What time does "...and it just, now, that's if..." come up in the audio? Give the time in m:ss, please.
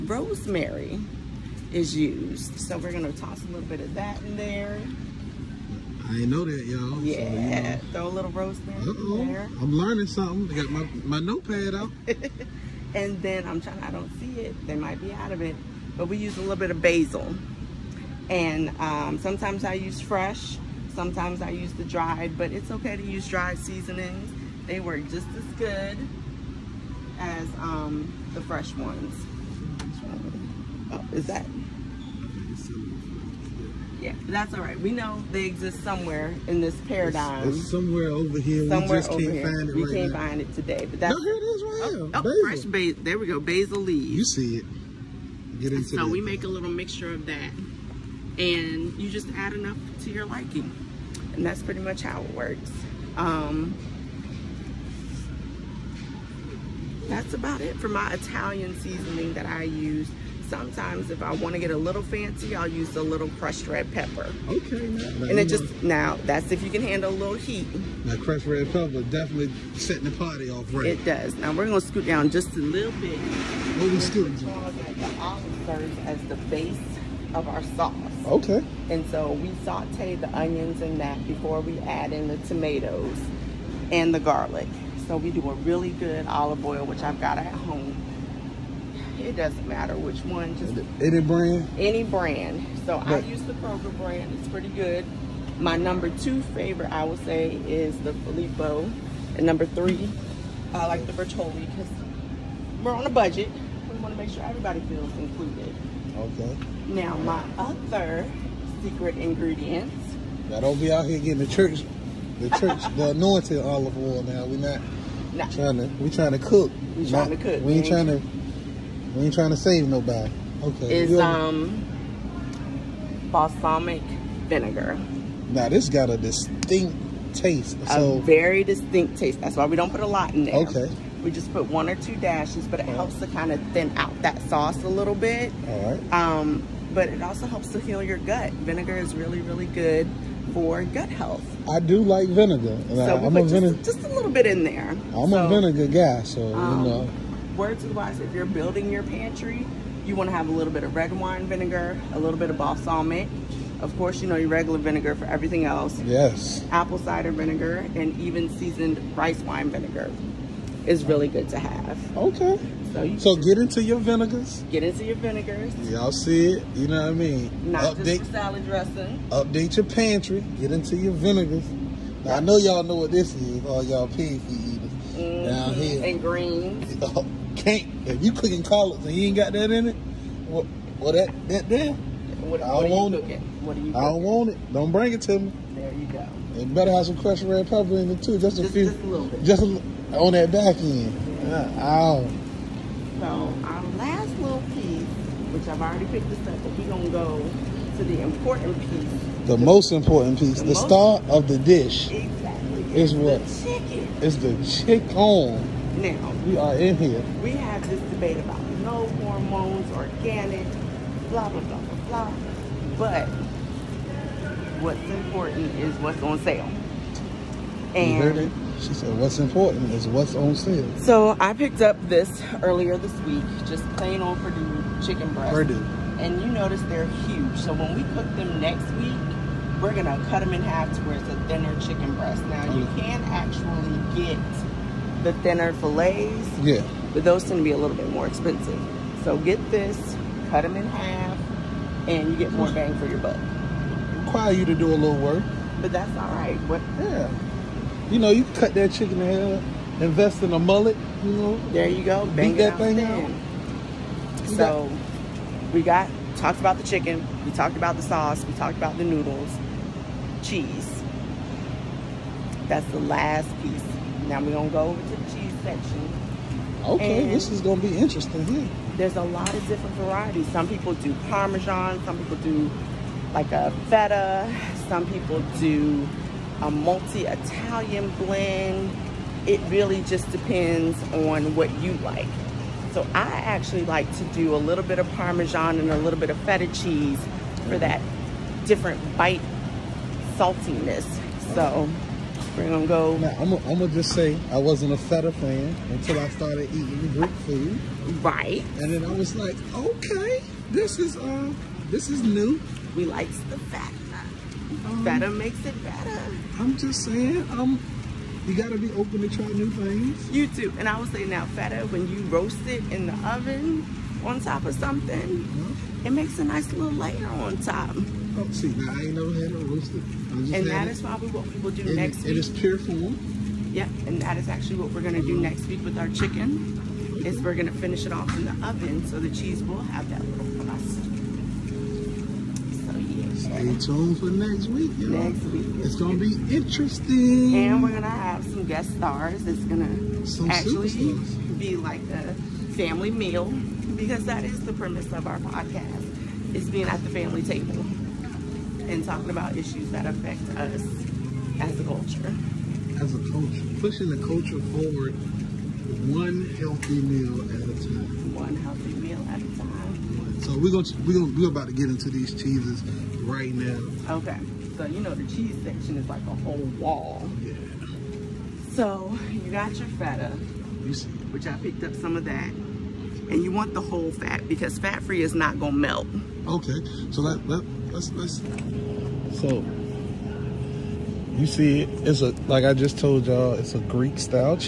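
1:05.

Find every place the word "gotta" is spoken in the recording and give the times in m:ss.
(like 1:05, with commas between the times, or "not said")
5:08.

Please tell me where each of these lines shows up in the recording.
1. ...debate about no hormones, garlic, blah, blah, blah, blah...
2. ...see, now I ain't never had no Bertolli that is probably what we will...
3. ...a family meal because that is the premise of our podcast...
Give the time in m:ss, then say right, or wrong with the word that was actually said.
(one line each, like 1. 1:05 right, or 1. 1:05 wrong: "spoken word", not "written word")
1. 3:28 wrong: "organic", not "garlic"
2. 5:18 wrong: "And", not "Bertolli"
3. 5:42 right.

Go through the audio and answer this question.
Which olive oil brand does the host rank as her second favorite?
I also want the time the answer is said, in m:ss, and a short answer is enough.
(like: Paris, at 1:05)
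Filippo, at 1:38.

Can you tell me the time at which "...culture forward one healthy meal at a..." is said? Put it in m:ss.
5:54.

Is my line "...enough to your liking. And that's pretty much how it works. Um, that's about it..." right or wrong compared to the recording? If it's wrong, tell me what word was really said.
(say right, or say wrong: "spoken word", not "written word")
right.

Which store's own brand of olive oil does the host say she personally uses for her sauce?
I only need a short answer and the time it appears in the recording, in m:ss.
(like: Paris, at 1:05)
Kroger, at 1:33.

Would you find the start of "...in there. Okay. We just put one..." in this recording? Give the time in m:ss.
2:10.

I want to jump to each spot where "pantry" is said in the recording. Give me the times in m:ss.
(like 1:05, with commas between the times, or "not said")
2:29, 2:49.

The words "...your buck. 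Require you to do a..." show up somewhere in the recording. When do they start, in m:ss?
4:03.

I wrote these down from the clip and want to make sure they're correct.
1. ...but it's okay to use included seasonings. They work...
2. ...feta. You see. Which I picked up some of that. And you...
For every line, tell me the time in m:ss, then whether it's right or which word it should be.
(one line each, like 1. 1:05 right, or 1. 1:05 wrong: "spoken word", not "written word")
1. 0:22 wrong: "dried", not "included"
2. 6:09 right.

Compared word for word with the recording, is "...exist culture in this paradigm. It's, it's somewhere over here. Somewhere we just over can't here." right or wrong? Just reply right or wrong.
wrong.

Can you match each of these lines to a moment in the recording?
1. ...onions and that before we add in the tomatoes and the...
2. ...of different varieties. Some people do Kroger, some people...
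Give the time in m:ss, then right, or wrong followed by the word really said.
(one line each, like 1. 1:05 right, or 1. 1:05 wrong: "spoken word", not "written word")
1. 1:20 right
2. 4:29 wrong: "Parmesan", not "Kroger".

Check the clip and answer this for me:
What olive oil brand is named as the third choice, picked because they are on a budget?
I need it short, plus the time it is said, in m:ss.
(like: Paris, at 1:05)
Bertolli, at 1:41.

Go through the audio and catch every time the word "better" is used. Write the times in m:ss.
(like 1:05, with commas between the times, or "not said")
3:06, 5:05.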